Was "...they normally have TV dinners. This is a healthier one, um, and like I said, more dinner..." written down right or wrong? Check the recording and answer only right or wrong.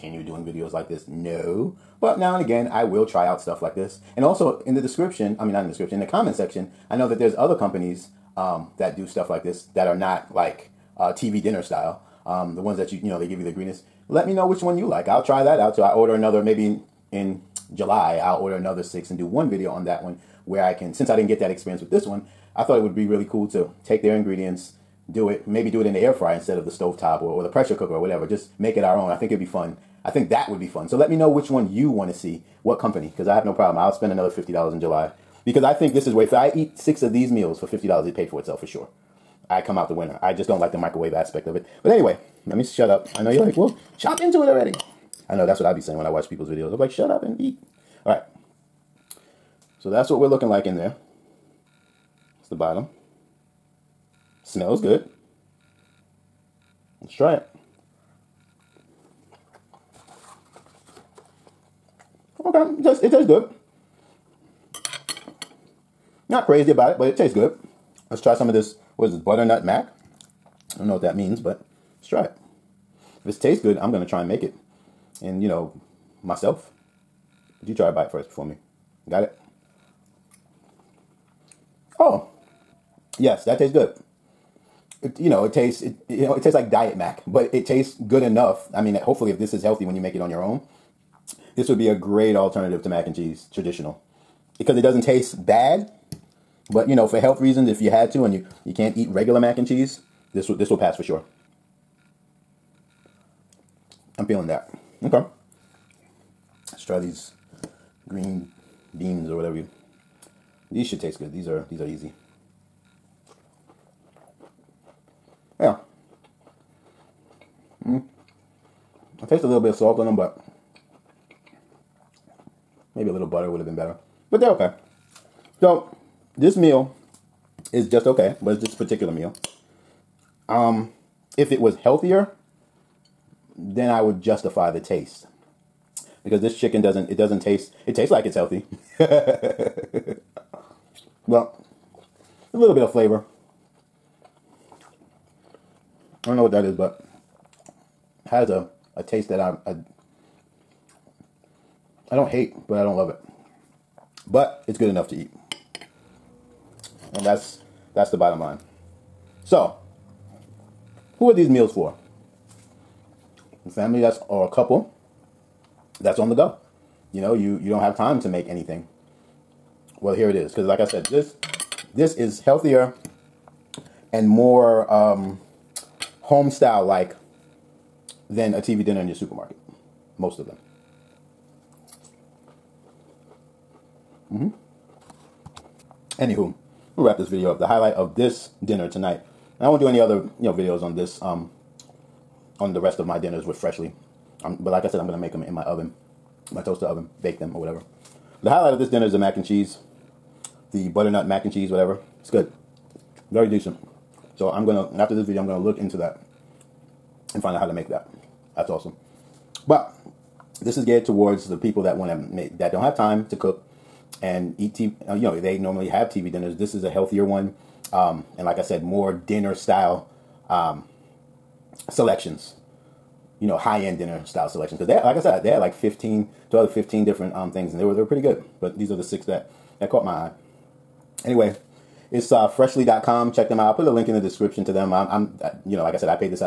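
right.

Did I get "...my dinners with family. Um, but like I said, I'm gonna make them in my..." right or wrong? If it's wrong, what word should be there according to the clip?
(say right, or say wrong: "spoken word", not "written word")
wrong: "freshly", not "family".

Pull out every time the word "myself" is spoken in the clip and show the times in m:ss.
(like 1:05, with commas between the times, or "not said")
1:16.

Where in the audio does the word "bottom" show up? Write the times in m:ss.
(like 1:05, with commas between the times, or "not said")
0:52, 2:38.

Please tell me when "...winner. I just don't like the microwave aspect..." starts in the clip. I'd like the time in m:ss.
0:39.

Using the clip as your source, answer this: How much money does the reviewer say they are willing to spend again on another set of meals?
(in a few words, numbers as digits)
$50.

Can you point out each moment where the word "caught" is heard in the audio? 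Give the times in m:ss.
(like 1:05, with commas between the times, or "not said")
3:49.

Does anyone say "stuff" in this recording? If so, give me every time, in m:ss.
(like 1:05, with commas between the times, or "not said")
0:03, 0:09.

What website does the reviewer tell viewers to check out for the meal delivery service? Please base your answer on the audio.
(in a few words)
freshly.com.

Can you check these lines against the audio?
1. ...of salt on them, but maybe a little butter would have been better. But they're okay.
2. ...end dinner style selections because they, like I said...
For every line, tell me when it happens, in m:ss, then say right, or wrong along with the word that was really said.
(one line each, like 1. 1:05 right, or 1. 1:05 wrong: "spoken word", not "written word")
1. 1:59 right
2. 3:43 right.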